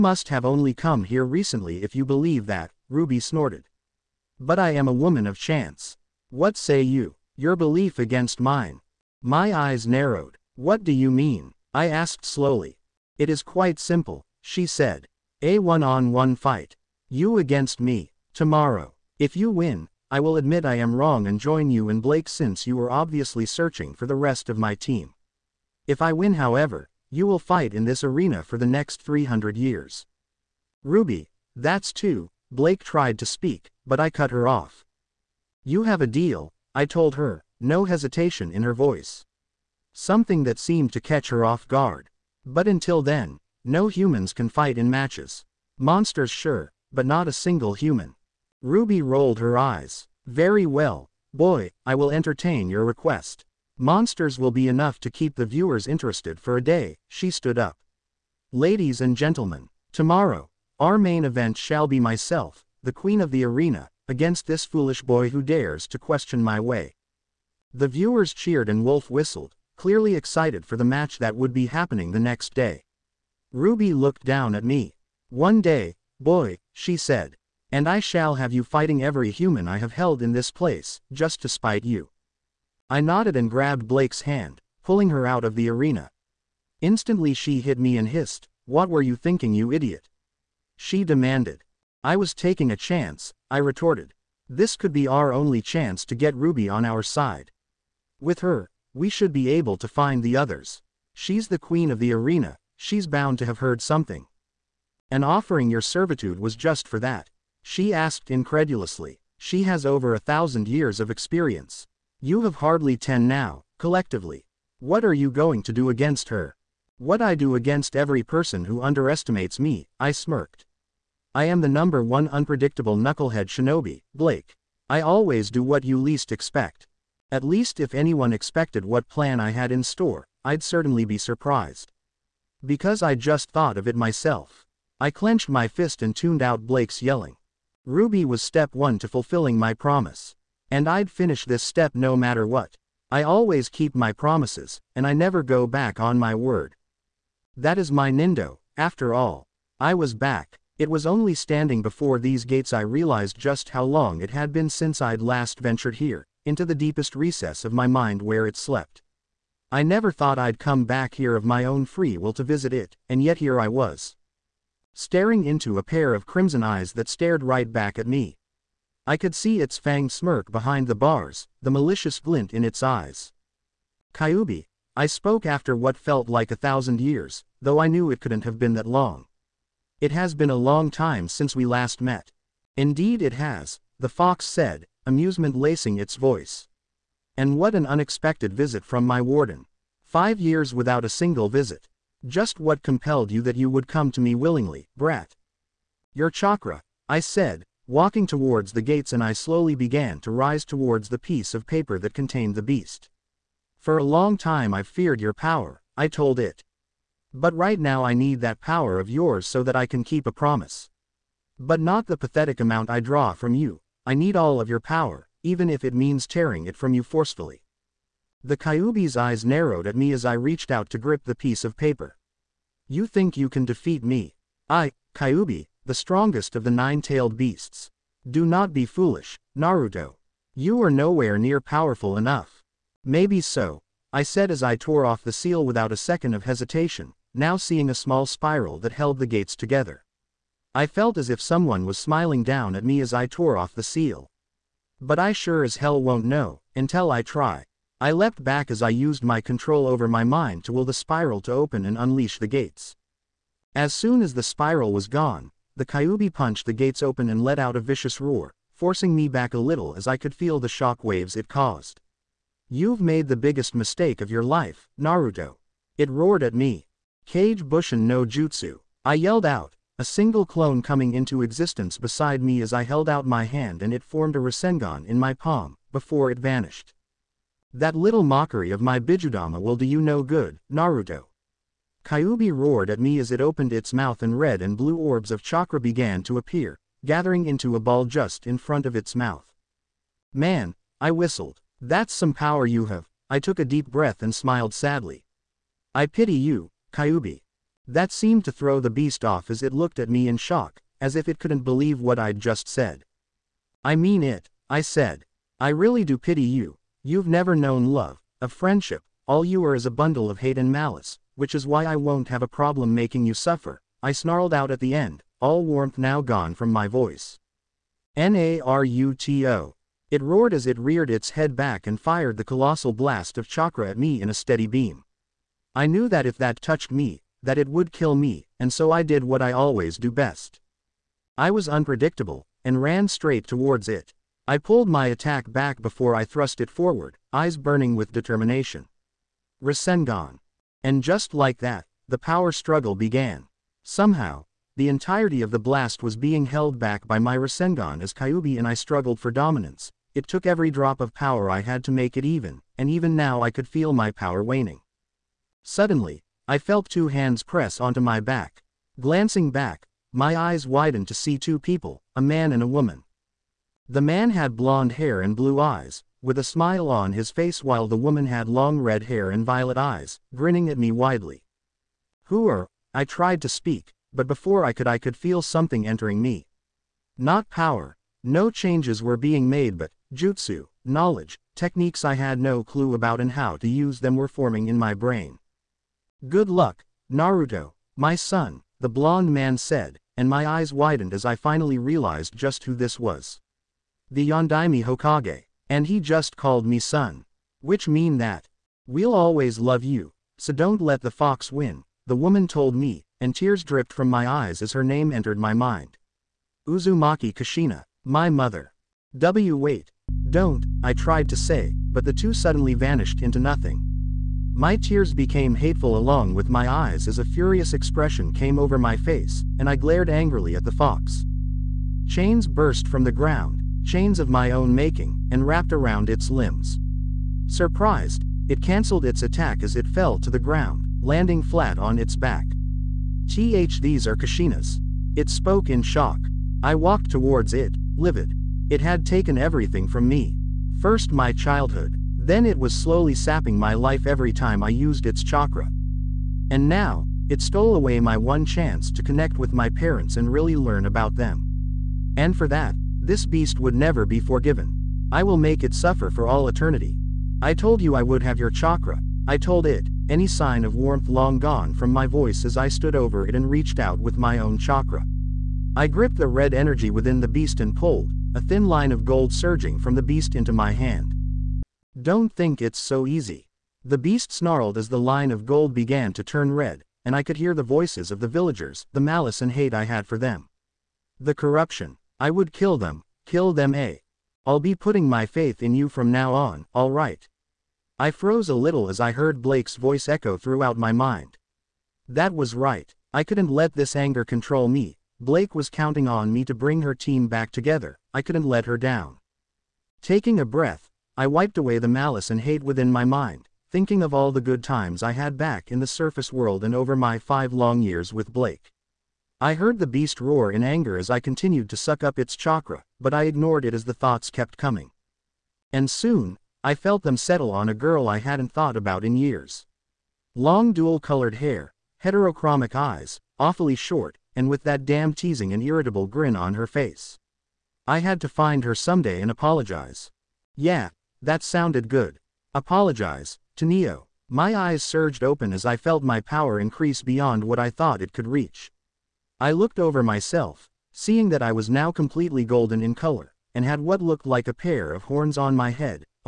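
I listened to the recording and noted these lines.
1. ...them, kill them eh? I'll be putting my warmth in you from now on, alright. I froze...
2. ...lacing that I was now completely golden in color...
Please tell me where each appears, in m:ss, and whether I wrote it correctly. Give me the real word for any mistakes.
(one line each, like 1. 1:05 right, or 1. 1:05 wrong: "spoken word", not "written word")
1. 8:02 wrong: "faith", not "warmth"
2. 9:00 wrong: "seeing", not "lacing".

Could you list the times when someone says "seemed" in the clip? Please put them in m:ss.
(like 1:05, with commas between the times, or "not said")
0:40, 4:58.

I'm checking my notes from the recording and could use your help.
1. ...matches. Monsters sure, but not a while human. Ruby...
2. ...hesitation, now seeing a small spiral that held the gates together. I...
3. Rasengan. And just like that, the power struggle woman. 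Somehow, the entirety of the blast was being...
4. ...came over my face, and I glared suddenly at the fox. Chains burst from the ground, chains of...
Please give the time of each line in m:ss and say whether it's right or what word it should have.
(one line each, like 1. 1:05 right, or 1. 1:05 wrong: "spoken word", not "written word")
1. 0:44 wrong: "single", not "while"
2. 3:56 right
3. 5:39 wrong: "began", not "woman"
4. 6:58 wrong: "angrily", not "suddenly".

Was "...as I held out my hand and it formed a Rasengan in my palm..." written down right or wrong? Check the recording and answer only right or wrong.
right.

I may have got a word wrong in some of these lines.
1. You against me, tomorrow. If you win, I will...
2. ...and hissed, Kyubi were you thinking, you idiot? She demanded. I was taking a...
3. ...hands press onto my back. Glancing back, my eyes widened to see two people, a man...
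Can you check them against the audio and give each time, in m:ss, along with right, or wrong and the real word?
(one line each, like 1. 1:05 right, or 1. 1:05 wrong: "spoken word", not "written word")
1. 0:17 right
2. 1:27 wrong: "What", not "Kyubi"
3. 5:57 right.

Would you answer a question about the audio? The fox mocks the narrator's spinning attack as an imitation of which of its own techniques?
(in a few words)
Bijudama.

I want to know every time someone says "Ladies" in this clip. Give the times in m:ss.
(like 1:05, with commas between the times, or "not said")
0:58.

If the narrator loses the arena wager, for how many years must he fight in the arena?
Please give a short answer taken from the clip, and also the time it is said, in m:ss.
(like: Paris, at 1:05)
300, at 0:29.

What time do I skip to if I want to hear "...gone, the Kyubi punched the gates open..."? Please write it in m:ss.
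4:15.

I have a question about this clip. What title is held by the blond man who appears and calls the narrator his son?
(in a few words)
Yondaime Hokage.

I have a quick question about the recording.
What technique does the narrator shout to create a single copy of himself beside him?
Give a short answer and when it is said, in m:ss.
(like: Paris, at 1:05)
Kage Bushin no Jutsu, at 4:27.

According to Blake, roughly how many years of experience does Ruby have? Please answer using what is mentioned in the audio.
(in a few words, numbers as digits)
Over 1,000.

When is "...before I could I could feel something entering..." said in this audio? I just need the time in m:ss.
6:14.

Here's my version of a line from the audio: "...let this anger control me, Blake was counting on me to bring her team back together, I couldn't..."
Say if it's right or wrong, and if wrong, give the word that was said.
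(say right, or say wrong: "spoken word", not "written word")
right.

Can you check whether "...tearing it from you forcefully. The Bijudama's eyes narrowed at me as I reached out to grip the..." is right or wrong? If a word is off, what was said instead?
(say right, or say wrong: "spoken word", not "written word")
wrong: "Kyubi", not "Bijudama".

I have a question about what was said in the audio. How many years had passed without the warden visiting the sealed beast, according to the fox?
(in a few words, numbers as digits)
5.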